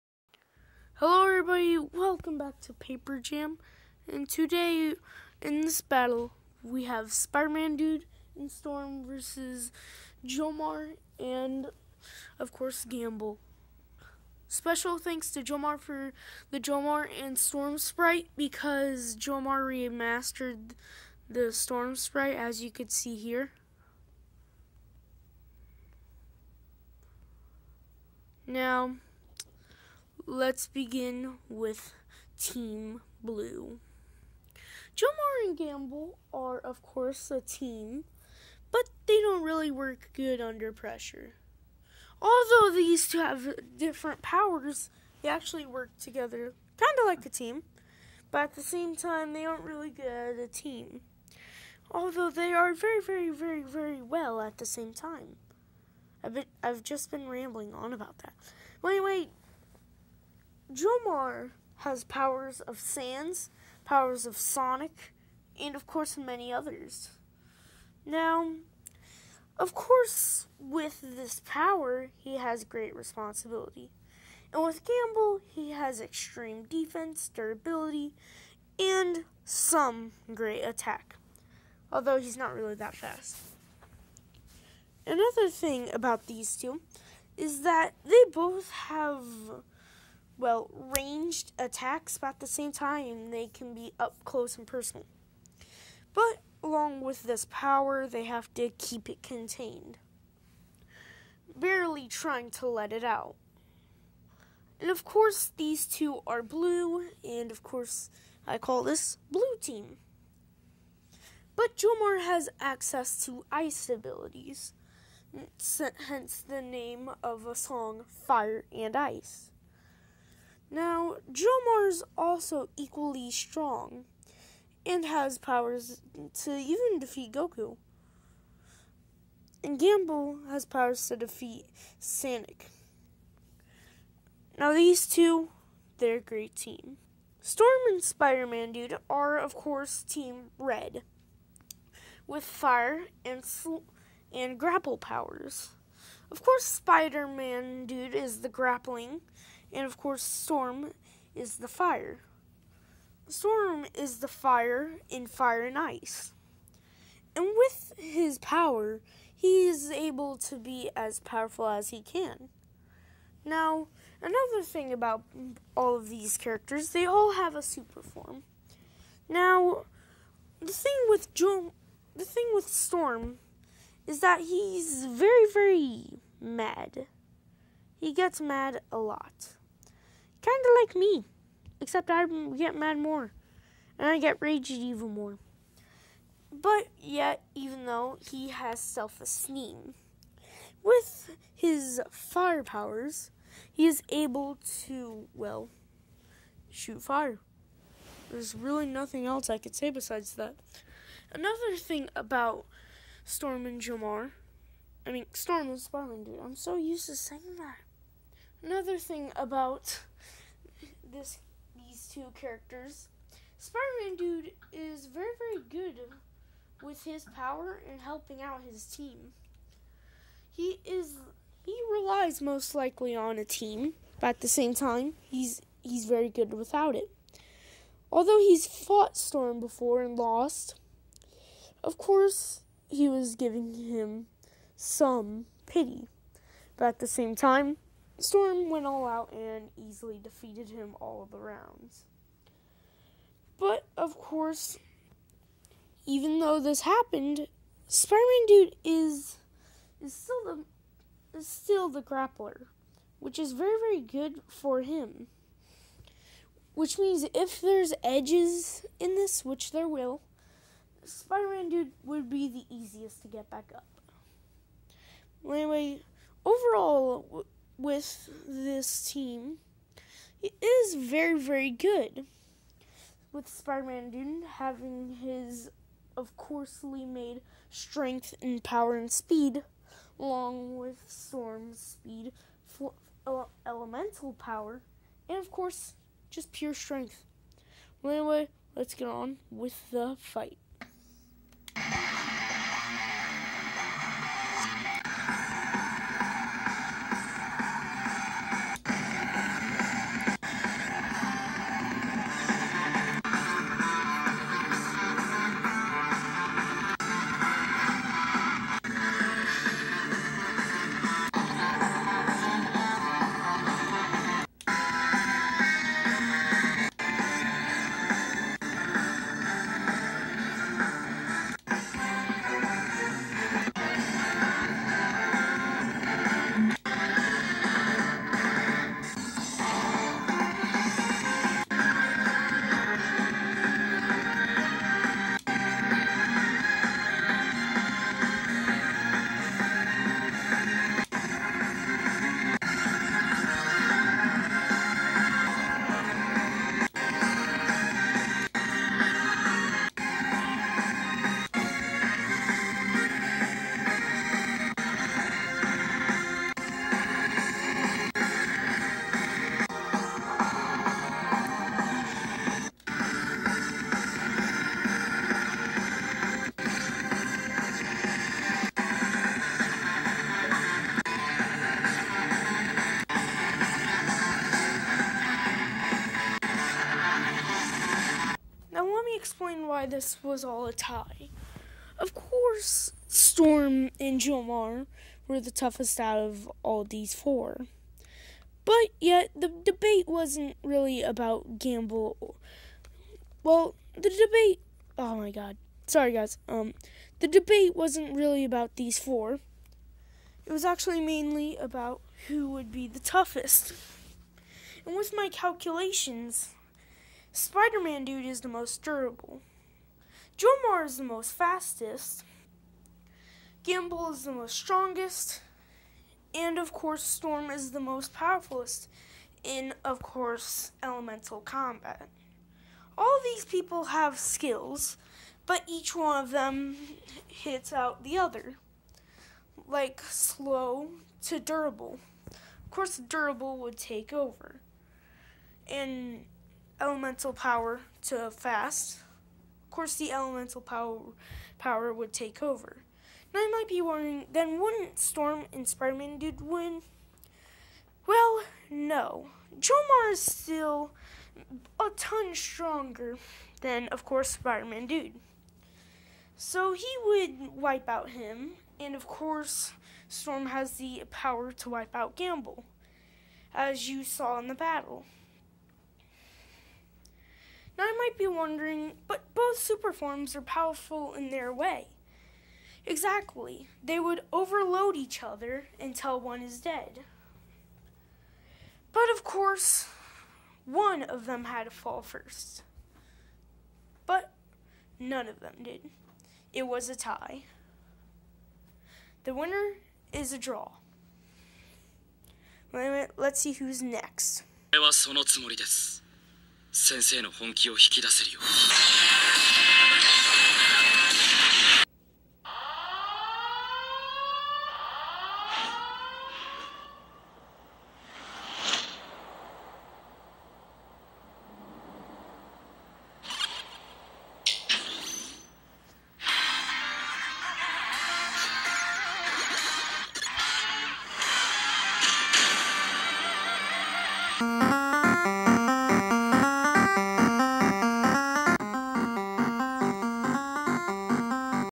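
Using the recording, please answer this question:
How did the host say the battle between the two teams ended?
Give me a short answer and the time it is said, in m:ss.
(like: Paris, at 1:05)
A draw, at 8:10.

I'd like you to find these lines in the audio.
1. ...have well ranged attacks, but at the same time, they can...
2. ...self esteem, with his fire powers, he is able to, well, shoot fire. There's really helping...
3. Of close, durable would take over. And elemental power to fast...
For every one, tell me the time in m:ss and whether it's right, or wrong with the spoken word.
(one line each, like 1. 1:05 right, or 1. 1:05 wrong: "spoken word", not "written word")
1. 1:28 right
2. 3:08 wrong: "nothing", not "helping"
3. 7:12 wrong: "course", not "close".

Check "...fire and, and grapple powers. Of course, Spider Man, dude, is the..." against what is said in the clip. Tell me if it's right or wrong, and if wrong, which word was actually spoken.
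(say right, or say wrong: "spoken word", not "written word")
right.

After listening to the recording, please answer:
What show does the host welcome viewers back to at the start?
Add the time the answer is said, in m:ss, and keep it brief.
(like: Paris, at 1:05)
Paper Jam, at 0:02.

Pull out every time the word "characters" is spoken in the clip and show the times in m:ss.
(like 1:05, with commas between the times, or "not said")
2:46, 3:32.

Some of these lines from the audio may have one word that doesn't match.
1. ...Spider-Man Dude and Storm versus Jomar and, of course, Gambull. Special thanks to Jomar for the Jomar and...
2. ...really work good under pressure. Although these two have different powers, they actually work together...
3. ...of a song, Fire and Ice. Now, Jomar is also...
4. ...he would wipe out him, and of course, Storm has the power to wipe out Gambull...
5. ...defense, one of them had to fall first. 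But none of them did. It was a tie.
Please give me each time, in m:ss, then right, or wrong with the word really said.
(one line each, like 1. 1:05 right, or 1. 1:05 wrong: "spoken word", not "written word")
1. 0:07 right
2. 0:39 right
3. 1:57 right
4. 7:36 right
5. 7:59 wrong: "course", not "defense".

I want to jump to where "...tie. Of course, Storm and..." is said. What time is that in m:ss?
6:20.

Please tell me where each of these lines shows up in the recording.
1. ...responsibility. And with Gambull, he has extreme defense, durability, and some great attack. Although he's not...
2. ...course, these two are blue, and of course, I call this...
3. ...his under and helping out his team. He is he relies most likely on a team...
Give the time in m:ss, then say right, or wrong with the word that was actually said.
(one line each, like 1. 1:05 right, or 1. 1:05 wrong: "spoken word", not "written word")
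1. 1:12 right
2. 1:45 right
3. 3:37 wrong: "power", not "under".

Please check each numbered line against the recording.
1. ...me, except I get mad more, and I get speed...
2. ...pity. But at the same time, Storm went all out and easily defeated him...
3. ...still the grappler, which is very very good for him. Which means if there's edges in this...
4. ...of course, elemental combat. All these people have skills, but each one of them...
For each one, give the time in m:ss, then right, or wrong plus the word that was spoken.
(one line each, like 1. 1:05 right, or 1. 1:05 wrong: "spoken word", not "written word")
1. 3:00 wrong: "raged", not "speed"
2. 3:55 right
3. 4:11 right
4. 6:59 right.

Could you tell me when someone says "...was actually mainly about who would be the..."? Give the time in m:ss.
6:40.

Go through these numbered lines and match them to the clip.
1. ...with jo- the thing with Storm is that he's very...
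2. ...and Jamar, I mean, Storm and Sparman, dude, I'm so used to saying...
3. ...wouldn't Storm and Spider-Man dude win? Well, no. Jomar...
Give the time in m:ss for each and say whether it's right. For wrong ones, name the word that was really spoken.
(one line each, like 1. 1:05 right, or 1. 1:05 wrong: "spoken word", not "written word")
1. 2:51 right
2. 3:23 right
3. 7:24 right.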